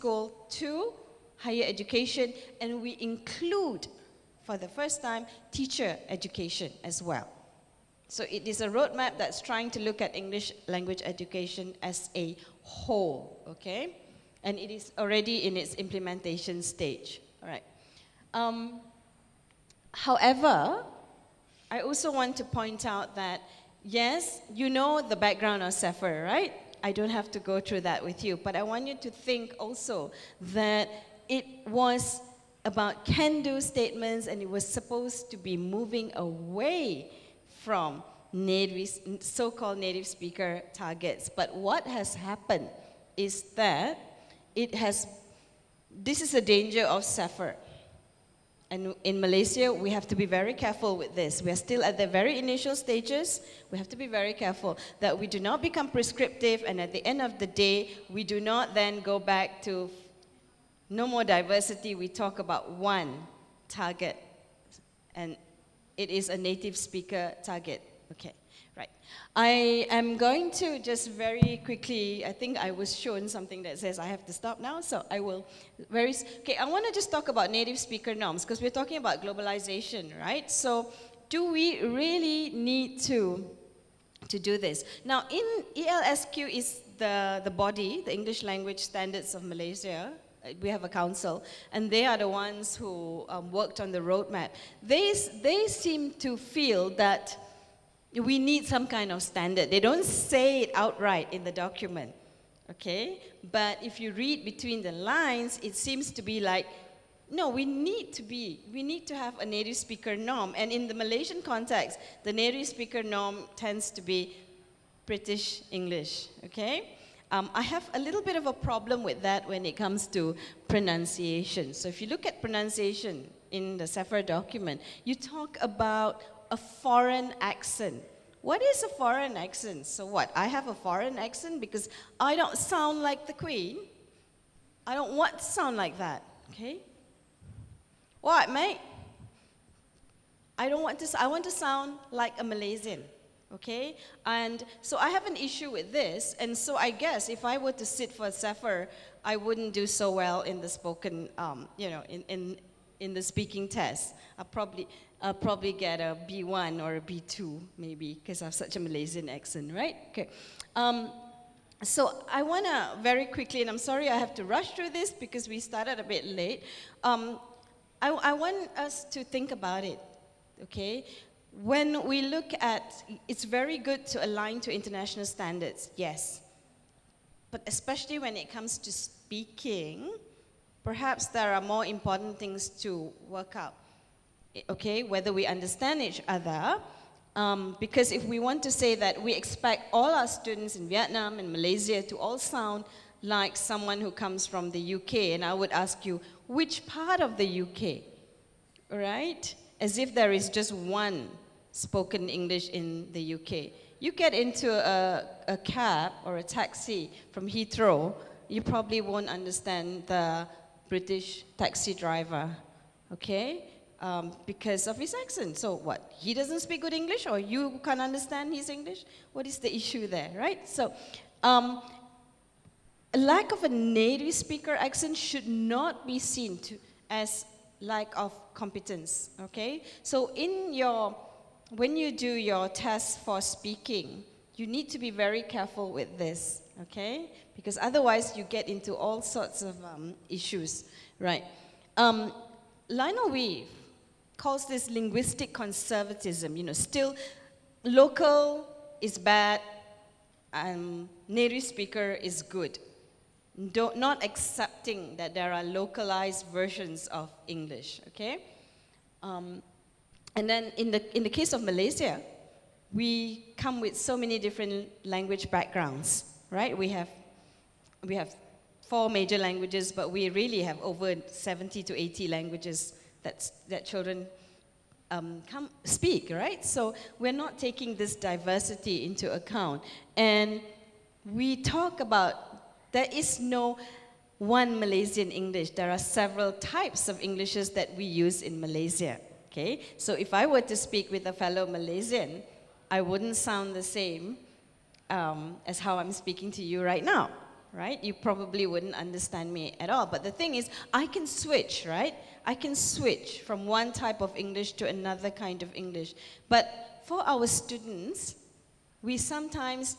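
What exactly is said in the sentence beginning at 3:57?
Because otherwise you get into all sorts of um, issues, right?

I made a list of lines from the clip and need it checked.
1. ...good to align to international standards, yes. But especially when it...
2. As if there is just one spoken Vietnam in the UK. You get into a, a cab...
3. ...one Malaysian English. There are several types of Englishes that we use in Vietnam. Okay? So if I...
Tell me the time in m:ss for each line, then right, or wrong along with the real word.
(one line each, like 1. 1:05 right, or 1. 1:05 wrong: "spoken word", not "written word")
1. 2:53 right
2. 3:19 wrong: "English", not "Vietnam"
3. 4:44 wrong: "Malaysia", not "Vietnam".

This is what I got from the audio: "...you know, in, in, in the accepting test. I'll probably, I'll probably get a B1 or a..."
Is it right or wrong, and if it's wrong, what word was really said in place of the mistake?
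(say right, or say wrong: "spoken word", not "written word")
wrong: "speaking", not "accepting".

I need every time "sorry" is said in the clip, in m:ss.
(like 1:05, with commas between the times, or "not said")
2:43.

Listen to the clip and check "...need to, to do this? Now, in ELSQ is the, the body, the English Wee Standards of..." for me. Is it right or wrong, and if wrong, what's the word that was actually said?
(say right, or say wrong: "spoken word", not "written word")
wrong: "Language", not "Wee".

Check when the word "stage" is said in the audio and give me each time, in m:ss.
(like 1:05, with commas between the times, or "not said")
0:16, 0:52.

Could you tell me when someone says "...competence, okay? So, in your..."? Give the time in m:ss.
3:48.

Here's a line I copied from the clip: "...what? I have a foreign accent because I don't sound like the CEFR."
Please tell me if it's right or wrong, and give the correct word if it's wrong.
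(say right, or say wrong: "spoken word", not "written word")
wrong: "Queen", not "CEFR".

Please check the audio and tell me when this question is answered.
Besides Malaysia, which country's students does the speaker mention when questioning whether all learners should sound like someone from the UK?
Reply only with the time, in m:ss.
3:10.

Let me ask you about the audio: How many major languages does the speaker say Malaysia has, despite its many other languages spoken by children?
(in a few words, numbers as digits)
4.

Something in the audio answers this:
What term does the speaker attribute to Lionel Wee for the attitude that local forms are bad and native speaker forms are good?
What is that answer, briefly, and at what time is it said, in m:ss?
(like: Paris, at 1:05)
linguistic conservatism, at 4:04.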